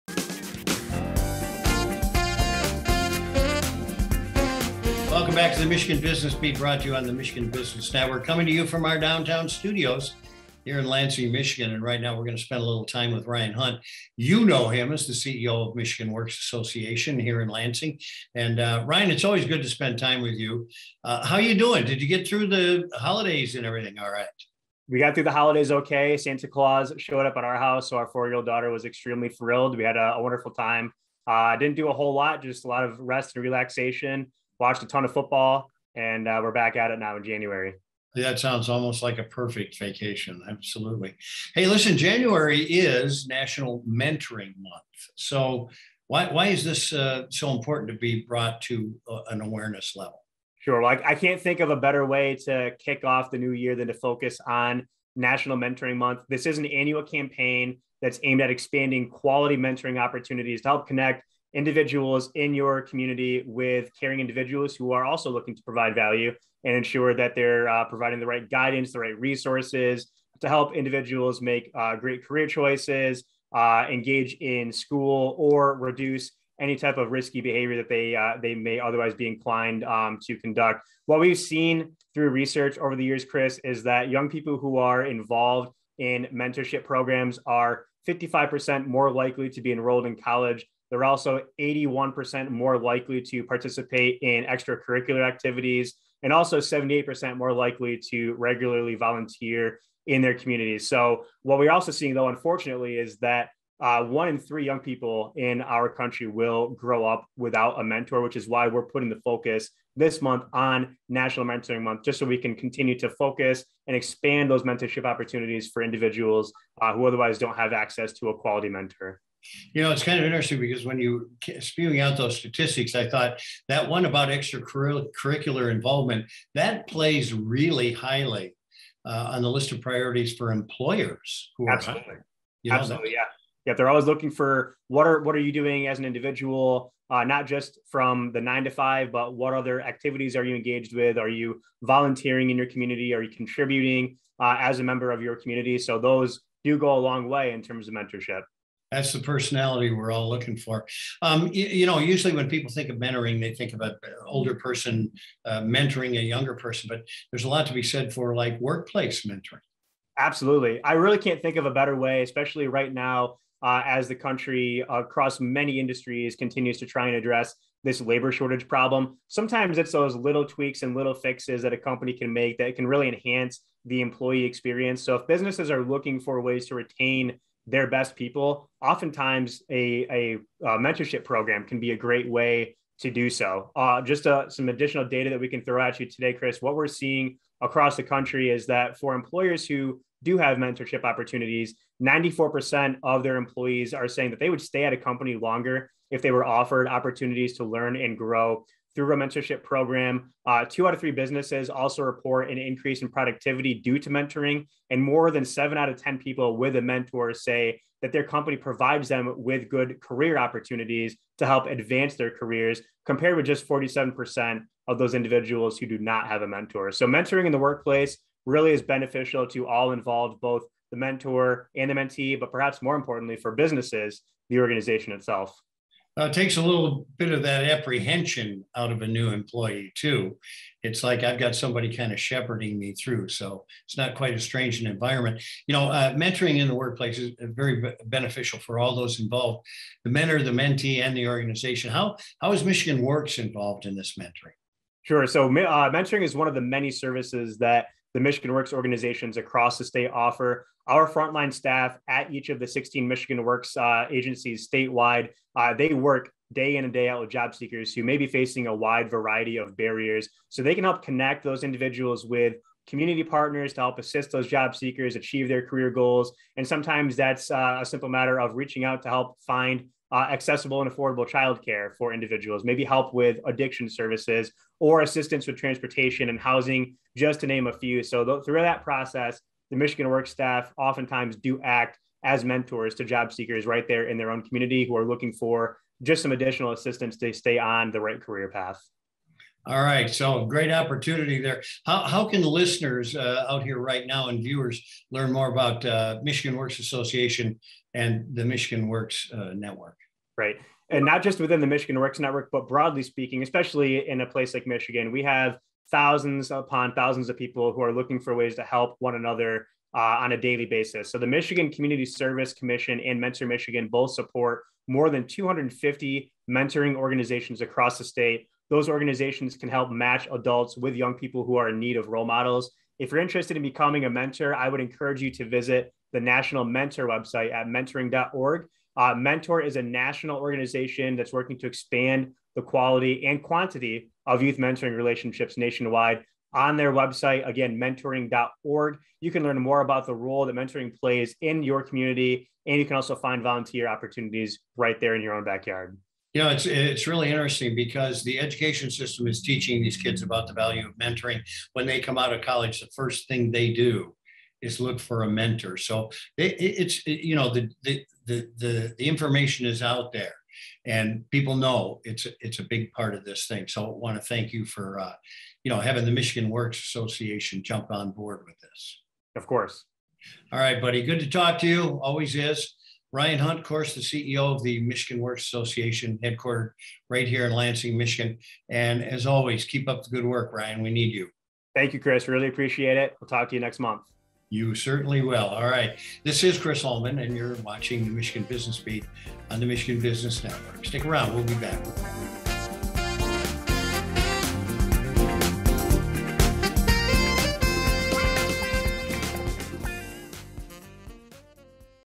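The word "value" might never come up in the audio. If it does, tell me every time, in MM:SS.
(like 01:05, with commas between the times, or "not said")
01:05, 05:50.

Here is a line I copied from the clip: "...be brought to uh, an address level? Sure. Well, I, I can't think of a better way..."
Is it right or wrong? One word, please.
wrong.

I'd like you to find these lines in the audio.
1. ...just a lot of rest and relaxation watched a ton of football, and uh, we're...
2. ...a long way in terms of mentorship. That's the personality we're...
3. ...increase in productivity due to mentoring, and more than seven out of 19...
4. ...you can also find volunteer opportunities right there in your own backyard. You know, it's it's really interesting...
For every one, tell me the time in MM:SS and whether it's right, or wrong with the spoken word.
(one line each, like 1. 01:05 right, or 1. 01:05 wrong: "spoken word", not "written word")
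1. 00:32 right
2. 02:26 right
3. 03:22 wrong: "10", not "19"
4. 05:42 right.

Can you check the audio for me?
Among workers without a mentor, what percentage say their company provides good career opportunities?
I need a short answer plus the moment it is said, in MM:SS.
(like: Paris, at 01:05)
47%, at 03:33.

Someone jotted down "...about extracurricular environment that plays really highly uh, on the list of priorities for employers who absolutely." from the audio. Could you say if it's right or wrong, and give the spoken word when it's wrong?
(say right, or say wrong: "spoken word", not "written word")
wrong: "involvement", not "environment".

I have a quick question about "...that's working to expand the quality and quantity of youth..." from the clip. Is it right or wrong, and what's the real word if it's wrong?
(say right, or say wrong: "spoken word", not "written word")
right.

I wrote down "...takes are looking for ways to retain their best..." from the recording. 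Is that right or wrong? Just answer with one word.
wrong.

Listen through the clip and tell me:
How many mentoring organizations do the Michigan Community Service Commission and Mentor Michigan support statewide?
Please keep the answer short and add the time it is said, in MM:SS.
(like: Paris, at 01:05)
more than 250, at 05:14.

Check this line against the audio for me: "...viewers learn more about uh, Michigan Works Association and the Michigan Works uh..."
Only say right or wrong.
right.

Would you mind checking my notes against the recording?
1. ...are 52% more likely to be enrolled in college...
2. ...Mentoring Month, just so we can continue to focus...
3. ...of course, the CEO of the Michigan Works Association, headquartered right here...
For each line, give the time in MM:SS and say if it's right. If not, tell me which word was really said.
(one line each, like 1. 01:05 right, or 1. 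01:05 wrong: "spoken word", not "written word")
1. 01:27 wrong: "55", not "52"
2. 01:51 right
3. 06:13 right.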